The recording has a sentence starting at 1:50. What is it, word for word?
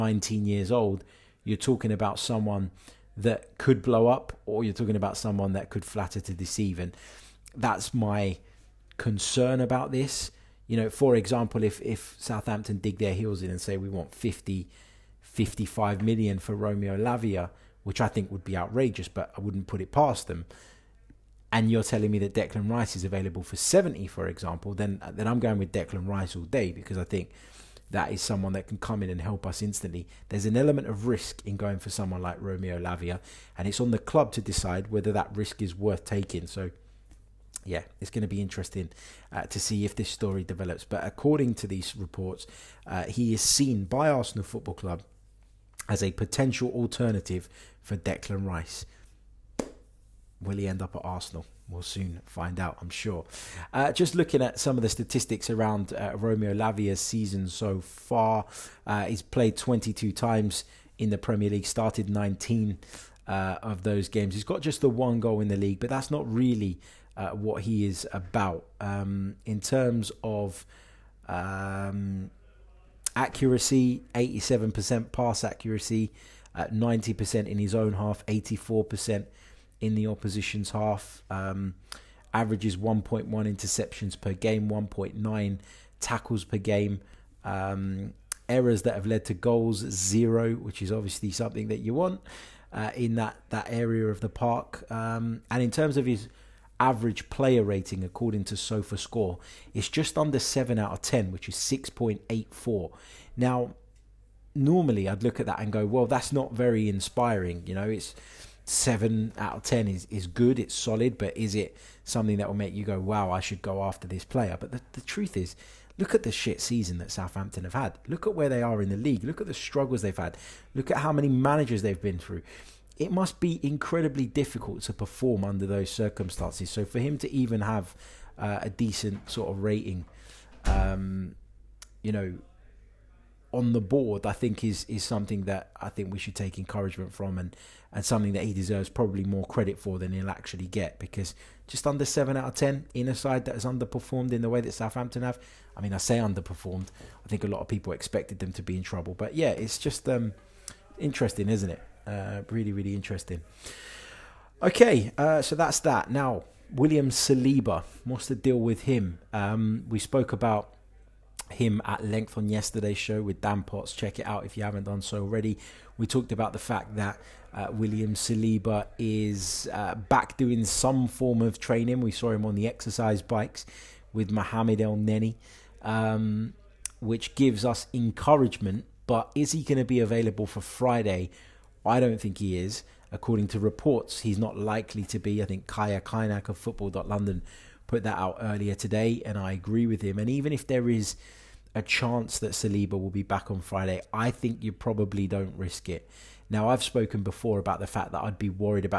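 It's solid, but is it something that will make you go, "Wow, I should go after this player"?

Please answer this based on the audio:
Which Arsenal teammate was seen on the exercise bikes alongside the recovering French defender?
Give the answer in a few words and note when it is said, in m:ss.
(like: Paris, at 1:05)
Mohamed Elneny, at 2:54.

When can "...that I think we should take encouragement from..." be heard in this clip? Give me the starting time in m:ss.
2:15.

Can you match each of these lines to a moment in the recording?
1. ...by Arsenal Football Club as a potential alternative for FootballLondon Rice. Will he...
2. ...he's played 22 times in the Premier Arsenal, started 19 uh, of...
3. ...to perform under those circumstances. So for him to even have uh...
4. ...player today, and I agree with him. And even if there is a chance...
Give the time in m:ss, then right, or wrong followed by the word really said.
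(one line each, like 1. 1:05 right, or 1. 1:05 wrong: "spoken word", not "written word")
1. 0:43 wrong: "Declan", not "FootballLondon"
2. 0:59 wrong: "League", not "Arsenal"
3. 2:04 right
4. 3:08 wrong: "earlier", not "player".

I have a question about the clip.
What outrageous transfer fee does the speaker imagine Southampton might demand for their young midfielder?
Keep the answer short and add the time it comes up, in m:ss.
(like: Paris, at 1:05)
50, 55 million, at 0:14.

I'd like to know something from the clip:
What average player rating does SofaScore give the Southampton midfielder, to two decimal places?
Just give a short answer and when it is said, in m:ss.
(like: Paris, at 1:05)
6.84, at 1:41.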